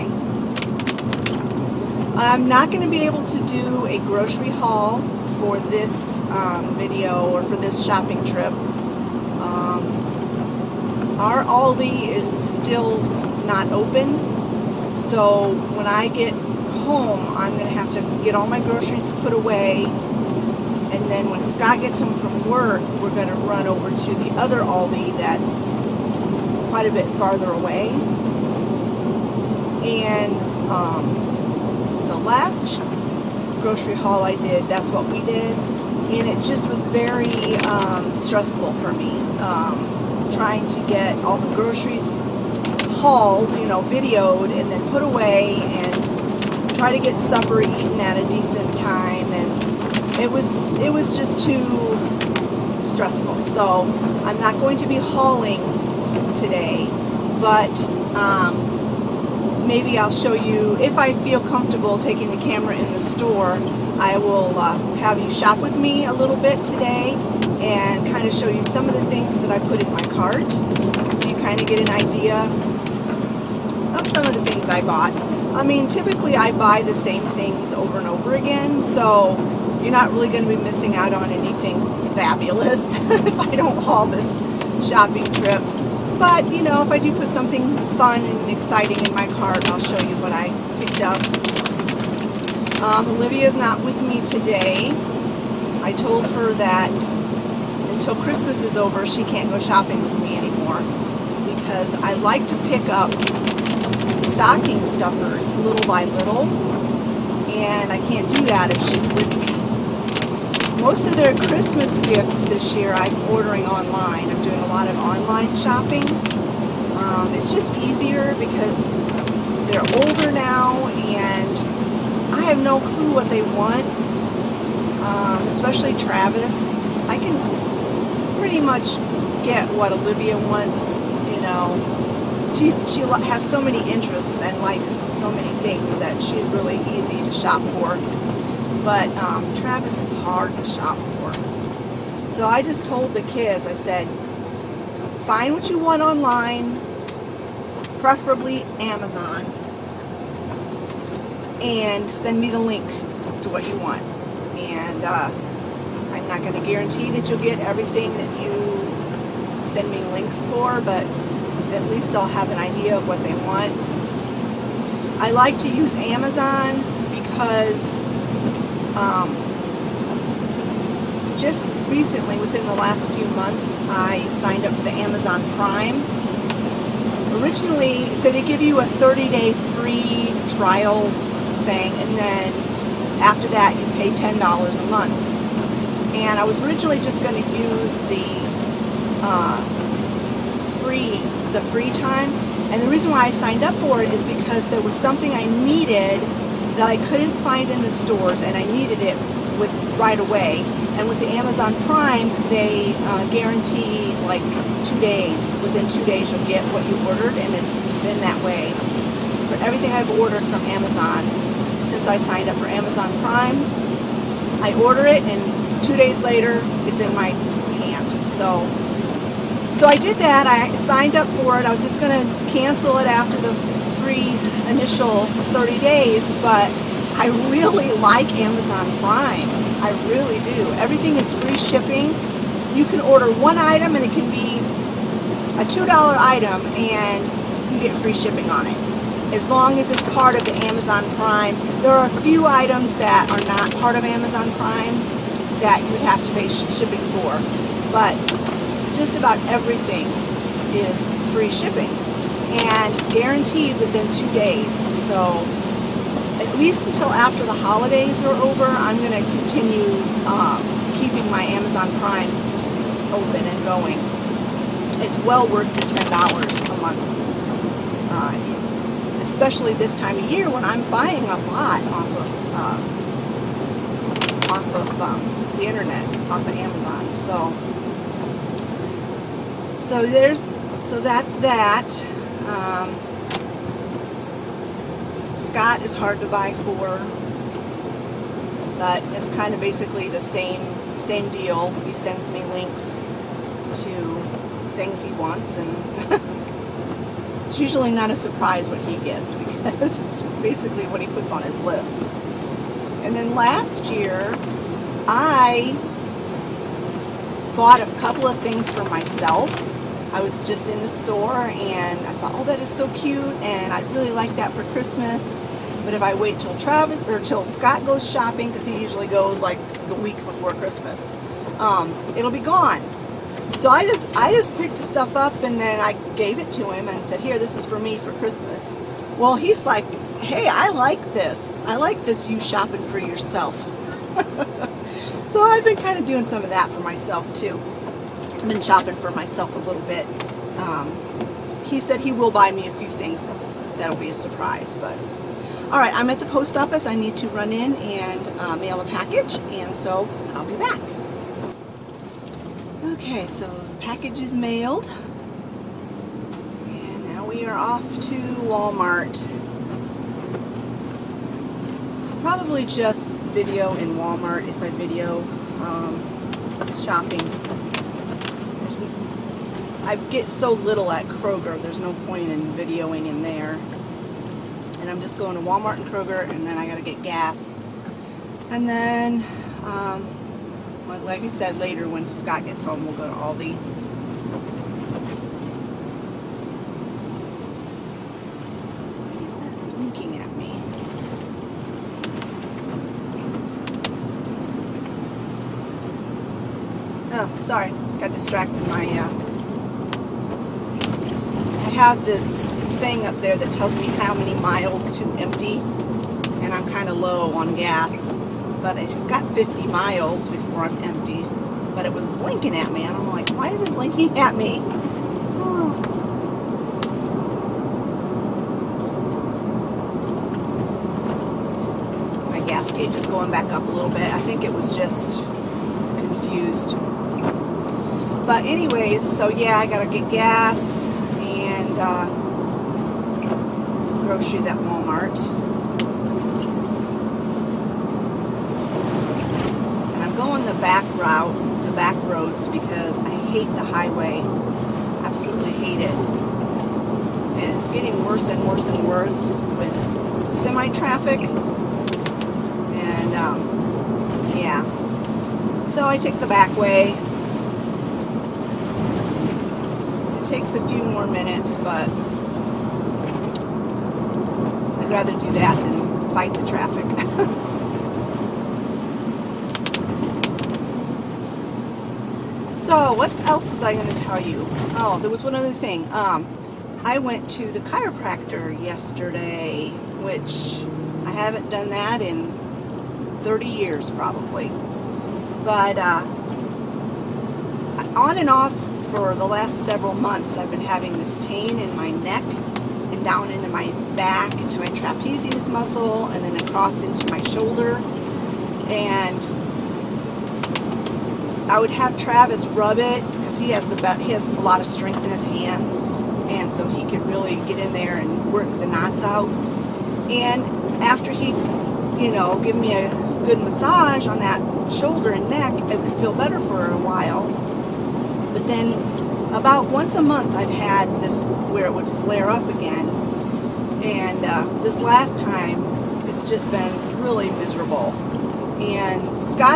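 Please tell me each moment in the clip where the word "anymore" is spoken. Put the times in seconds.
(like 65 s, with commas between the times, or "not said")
100 s.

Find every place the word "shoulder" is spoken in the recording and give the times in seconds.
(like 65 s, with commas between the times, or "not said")
497 s, 514 s.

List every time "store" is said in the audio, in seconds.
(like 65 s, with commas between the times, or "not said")
62 s, 197 s, 310 s.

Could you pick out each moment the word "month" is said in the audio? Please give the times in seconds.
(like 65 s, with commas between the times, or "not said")
173 s, 184 s, 266 s, 489 s, 520 s.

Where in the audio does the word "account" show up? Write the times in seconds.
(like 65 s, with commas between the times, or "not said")
not said.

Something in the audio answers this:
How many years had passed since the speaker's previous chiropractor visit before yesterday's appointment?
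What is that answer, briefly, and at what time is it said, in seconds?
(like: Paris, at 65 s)
30, at 483 s.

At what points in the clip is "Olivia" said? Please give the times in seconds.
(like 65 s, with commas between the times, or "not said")
93 s, 129 s.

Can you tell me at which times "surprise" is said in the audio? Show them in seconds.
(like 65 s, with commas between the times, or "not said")
298 s, 344 s.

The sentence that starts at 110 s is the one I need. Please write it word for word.
Most of their Christmas gifts this year I'm ordering online.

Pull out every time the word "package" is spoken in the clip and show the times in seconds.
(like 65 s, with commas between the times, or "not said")
348 s, 353 s.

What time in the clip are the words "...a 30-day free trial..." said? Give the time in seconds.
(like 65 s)
178 s.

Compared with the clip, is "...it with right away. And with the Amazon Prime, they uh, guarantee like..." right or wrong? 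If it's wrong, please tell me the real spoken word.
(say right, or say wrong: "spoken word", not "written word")
right.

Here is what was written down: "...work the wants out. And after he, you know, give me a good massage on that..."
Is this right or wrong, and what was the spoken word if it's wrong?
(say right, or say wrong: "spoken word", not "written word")
wrong: "knots", not "wants".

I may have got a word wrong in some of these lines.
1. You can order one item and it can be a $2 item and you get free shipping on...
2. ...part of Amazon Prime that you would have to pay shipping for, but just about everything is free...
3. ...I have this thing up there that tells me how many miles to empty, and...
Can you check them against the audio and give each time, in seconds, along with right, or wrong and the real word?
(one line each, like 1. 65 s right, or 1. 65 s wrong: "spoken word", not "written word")
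1. 232 s right
2. 243 s right
3. 401 s right.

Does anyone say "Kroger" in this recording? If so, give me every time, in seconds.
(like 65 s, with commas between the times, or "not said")
371 s, 375 s.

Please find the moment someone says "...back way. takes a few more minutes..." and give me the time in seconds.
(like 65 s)
456 s.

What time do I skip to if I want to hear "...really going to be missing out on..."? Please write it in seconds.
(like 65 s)
80 s.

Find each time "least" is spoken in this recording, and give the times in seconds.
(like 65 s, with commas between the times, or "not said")
161 s, 256 s.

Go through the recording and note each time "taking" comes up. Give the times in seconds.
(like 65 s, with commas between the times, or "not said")
61 s.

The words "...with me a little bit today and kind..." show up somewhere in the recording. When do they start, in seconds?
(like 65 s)
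65 s.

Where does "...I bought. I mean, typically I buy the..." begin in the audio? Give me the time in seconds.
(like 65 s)
74 s.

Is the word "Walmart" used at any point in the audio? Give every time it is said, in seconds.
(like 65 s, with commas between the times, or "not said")
358 s, 363 s, 375 s, 434 s.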